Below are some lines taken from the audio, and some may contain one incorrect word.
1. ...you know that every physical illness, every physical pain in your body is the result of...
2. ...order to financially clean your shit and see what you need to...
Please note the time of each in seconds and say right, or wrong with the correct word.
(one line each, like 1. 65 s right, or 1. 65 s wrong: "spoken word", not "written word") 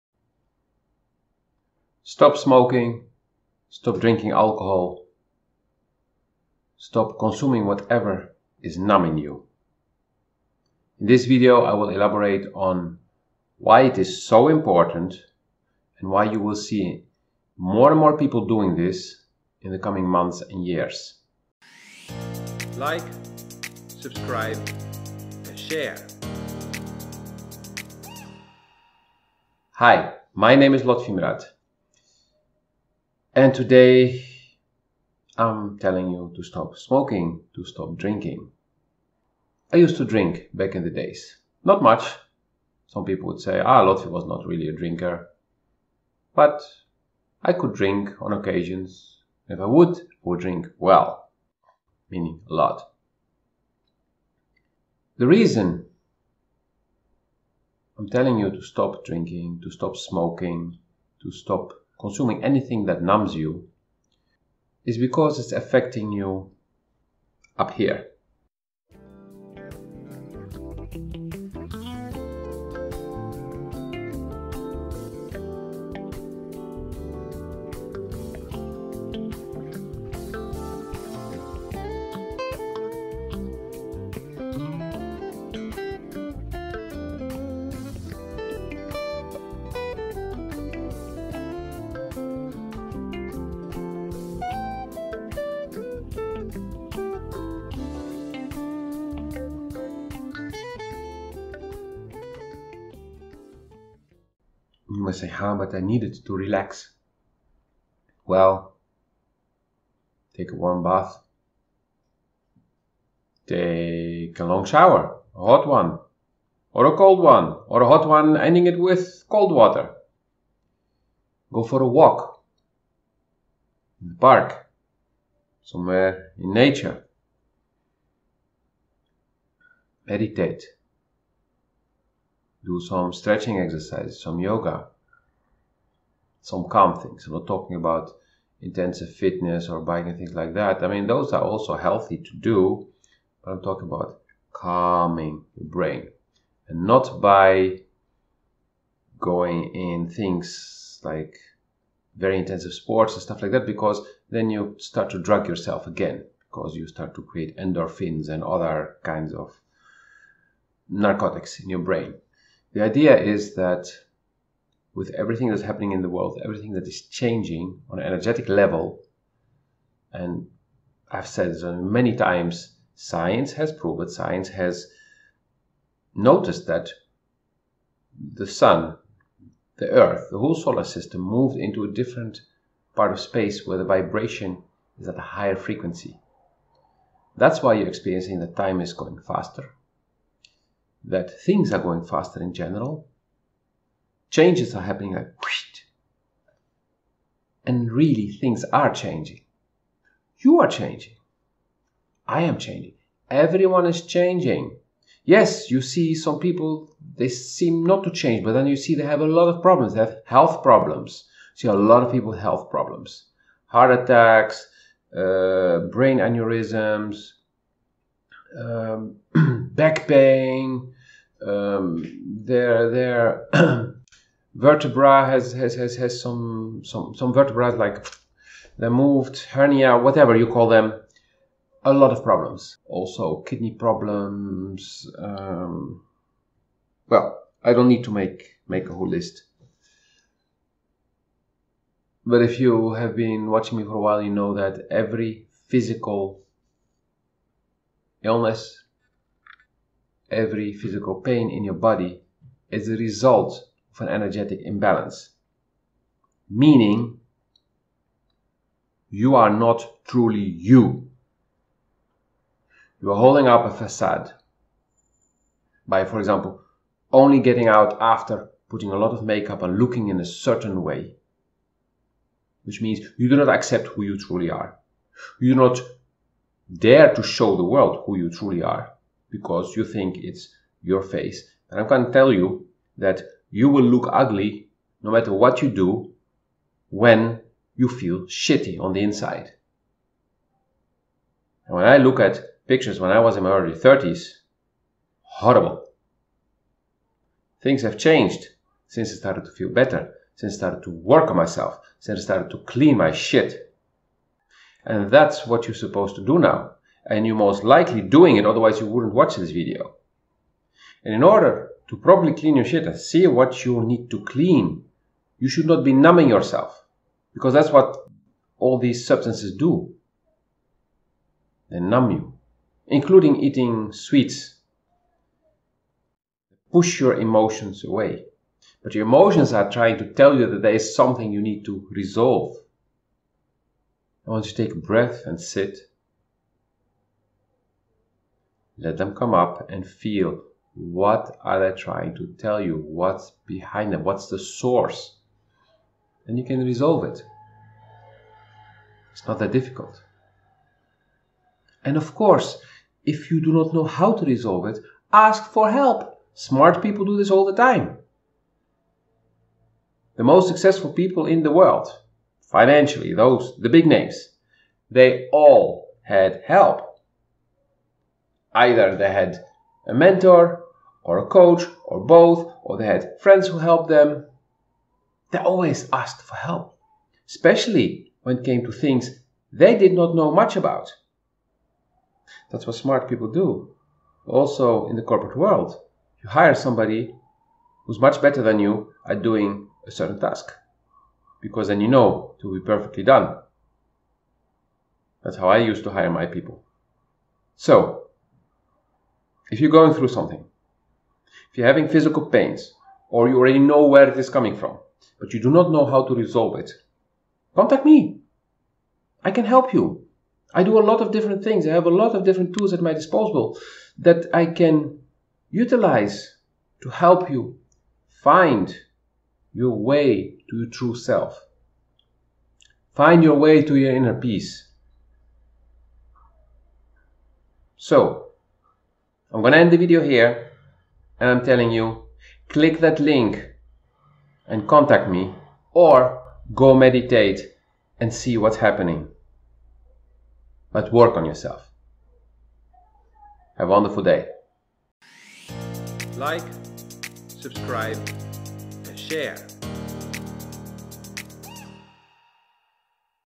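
1. 244 s right
2. 311 s wrong: "properly", not "financially".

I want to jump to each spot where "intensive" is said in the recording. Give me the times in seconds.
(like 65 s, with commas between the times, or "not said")
138 s, 152 s.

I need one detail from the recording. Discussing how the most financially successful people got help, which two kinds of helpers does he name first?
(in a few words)
a mentor or a coach.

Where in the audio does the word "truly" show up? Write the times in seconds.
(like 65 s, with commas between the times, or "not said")
260 s, 274 s, 278 s.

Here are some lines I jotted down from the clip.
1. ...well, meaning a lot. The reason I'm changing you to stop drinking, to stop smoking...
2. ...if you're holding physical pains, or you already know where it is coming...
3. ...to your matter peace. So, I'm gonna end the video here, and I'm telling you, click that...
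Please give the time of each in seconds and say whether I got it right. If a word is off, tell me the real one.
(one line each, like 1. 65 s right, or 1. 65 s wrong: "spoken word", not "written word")
1. 50 s wrong: "telling", not "changing"
2. 401 s wrong: "having", not "holding"
3. 423 s wrong: "inner", not "matter".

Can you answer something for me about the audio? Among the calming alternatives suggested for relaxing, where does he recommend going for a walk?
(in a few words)
the park.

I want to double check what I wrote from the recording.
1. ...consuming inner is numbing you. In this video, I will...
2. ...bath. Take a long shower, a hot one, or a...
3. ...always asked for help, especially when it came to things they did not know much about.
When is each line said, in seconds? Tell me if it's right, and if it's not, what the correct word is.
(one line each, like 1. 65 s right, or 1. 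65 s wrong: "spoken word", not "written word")
1. 7 s wrong: "whatever", not "inner"
2. 110 s right
3. 375 s right.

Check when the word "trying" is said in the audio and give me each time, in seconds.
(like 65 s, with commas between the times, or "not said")
329 s, 341 s.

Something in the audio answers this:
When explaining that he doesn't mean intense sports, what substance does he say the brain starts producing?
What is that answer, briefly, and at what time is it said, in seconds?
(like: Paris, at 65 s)
endorphins, at 157 s.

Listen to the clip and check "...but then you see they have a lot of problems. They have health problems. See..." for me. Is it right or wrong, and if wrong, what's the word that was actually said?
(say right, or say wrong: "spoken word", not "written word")
right.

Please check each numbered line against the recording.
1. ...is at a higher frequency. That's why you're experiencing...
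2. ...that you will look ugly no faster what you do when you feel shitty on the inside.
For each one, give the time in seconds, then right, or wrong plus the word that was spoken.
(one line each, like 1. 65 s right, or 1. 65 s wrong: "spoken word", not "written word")
1. 184 s right
2. 282 s wrong: "matter", not "faster".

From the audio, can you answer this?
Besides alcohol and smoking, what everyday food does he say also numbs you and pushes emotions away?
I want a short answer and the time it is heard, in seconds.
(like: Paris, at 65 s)
sweets, at 323 s.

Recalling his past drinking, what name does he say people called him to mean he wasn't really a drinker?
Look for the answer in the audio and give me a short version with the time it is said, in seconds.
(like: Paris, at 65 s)
Lotfi, at 43 s.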